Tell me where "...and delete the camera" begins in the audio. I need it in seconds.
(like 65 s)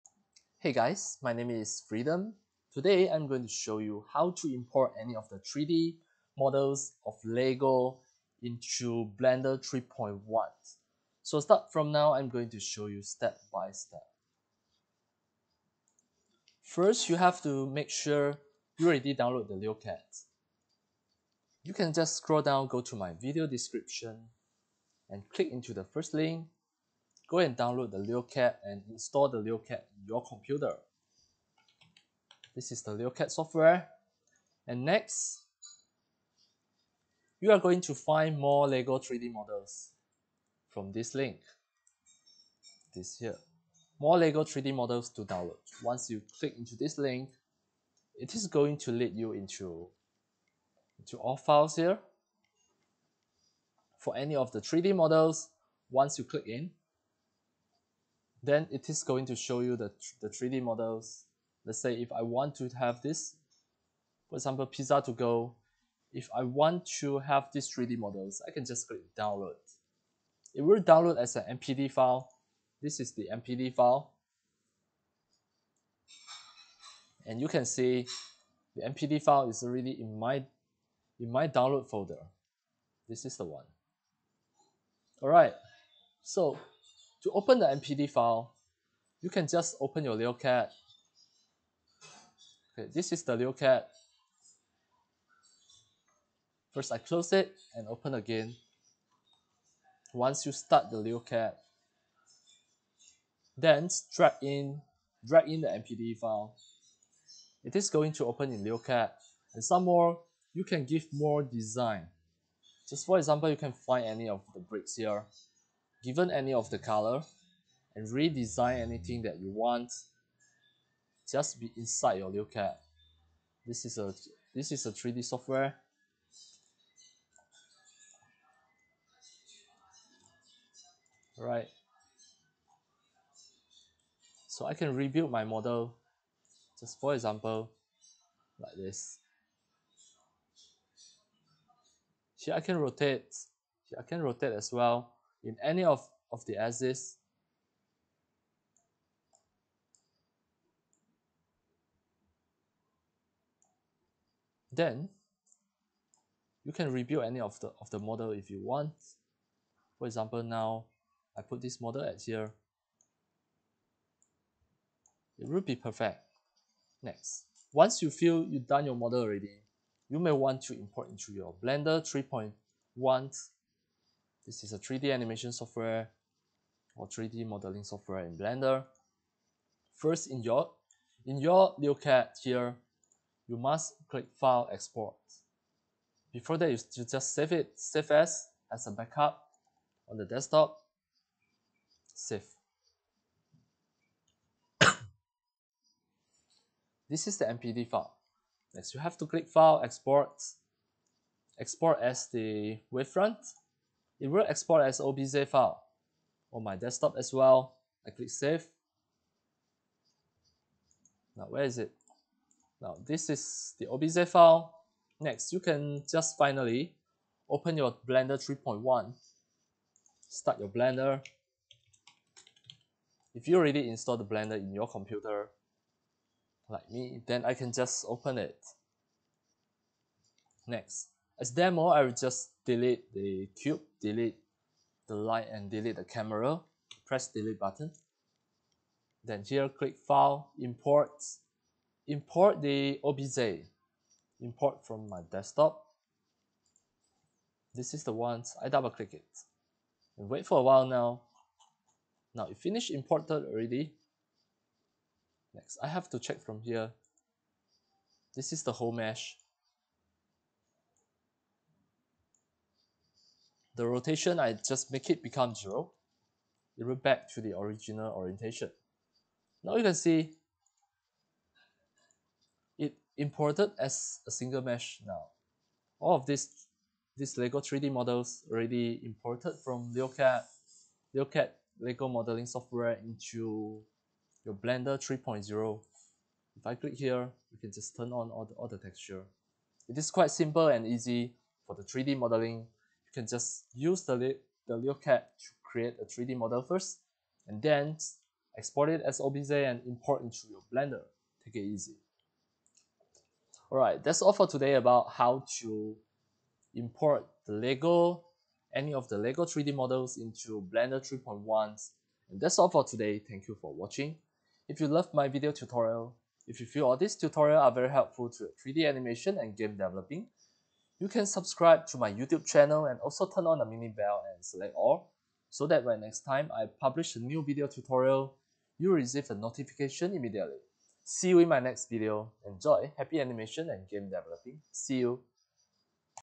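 235 s.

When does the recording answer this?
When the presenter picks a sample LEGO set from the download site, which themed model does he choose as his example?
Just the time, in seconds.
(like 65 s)
64 s.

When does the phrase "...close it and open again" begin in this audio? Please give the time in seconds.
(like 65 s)
96 s.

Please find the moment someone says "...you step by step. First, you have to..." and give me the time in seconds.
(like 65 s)
12 s.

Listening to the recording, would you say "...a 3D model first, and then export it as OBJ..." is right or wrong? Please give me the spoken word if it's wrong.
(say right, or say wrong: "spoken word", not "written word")
right.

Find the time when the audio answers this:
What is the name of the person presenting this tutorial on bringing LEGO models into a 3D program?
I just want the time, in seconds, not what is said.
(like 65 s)
1 s.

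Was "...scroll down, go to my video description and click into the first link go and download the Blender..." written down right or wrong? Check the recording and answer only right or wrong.
wrong.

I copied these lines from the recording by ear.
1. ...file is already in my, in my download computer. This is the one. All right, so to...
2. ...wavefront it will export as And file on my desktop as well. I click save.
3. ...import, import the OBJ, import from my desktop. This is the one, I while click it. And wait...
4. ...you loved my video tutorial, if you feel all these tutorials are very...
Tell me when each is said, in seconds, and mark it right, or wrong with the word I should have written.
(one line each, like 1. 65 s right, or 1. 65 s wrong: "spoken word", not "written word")
1. 79 s wrong: "folder", not "computer"
2. 202 s wrong: "OBJ", not "And"
3. 240 s wrong: "double", not "while"
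4. 314 s right.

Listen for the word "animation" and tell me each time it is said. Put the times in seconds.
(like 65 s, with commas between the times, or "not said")
175 s, 318 s, 333 s.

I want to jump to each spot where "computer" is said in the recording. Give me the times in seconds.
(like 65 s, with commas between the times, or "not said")
30 s, 224 s.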